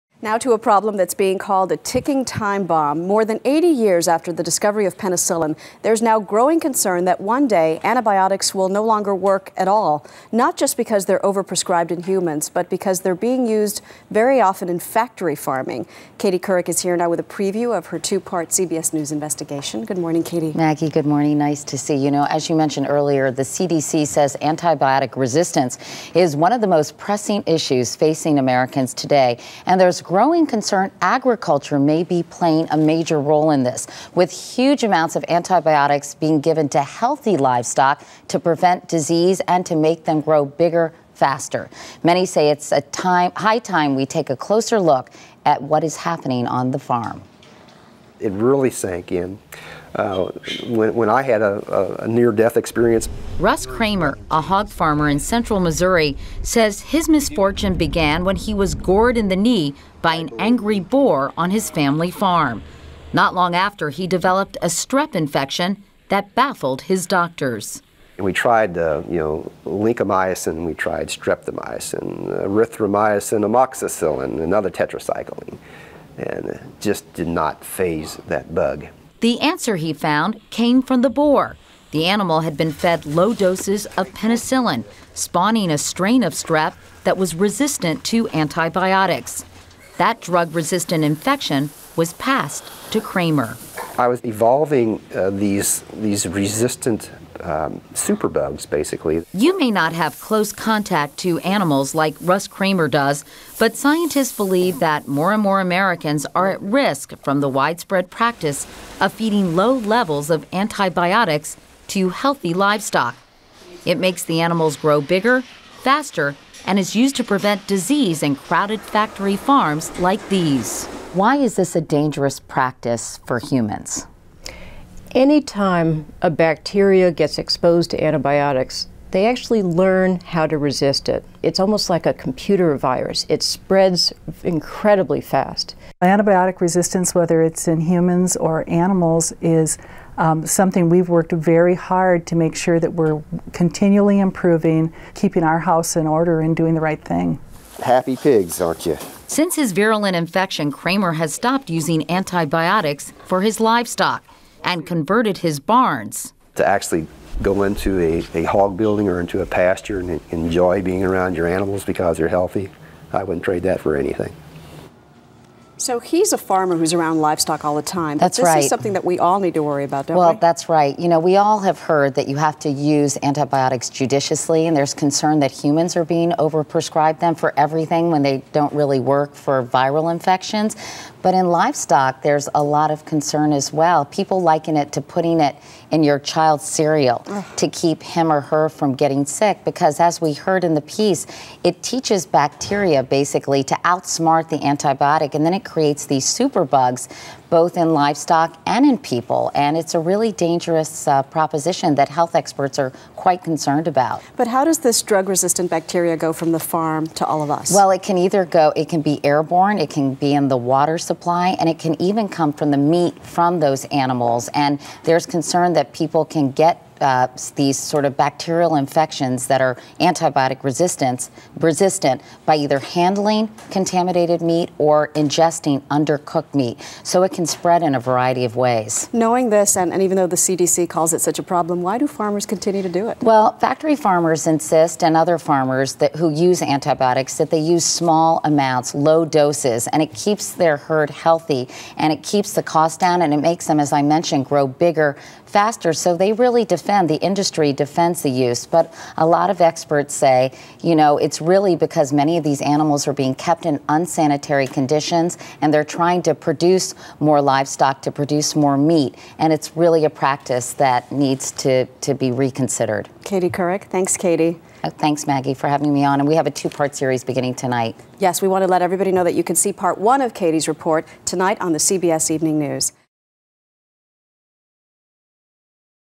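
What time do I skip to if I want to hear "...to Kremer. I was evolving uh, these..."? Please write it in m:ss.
1:32.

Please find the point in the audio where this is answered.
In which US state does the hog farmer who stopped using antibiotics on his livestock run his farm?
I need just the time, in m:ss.
0:55.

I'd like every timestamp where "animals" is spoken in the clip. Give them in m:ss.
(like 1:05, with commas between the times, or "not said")
1:22, 1:41, 1:54, 2:18, 2:41, 3:33, 4:12.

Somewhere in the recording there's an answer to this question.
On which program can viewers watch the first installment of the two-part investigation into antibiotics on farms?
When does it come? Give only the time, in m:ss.
4:31.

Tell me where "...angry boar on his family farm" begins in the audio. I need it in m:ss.
1:00.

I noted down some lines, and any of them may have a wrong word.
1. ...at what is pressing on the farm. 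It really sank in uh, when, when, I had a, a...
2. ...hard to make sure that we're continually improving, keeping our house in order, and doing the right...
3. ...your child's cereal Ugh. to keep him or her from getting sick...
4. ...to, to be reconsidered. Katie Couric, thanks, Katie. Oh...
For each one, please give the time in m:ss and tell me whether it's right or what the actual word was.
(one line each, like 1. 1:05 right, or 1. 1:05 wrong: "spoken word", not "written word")
1. 0:45 wrong: "happening", not "pressing"
2. 2:21 right
3. 3:06 right
4. 4:21 right.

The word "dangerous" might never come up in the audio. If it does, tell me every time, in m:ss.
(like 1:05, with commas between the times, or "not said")
2:01, 3:20.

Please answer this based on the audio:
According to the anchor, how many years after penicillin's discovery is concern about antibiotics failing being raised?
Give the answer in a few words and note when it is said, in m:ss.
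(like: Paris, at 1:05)
More than 80 years, at 0:03.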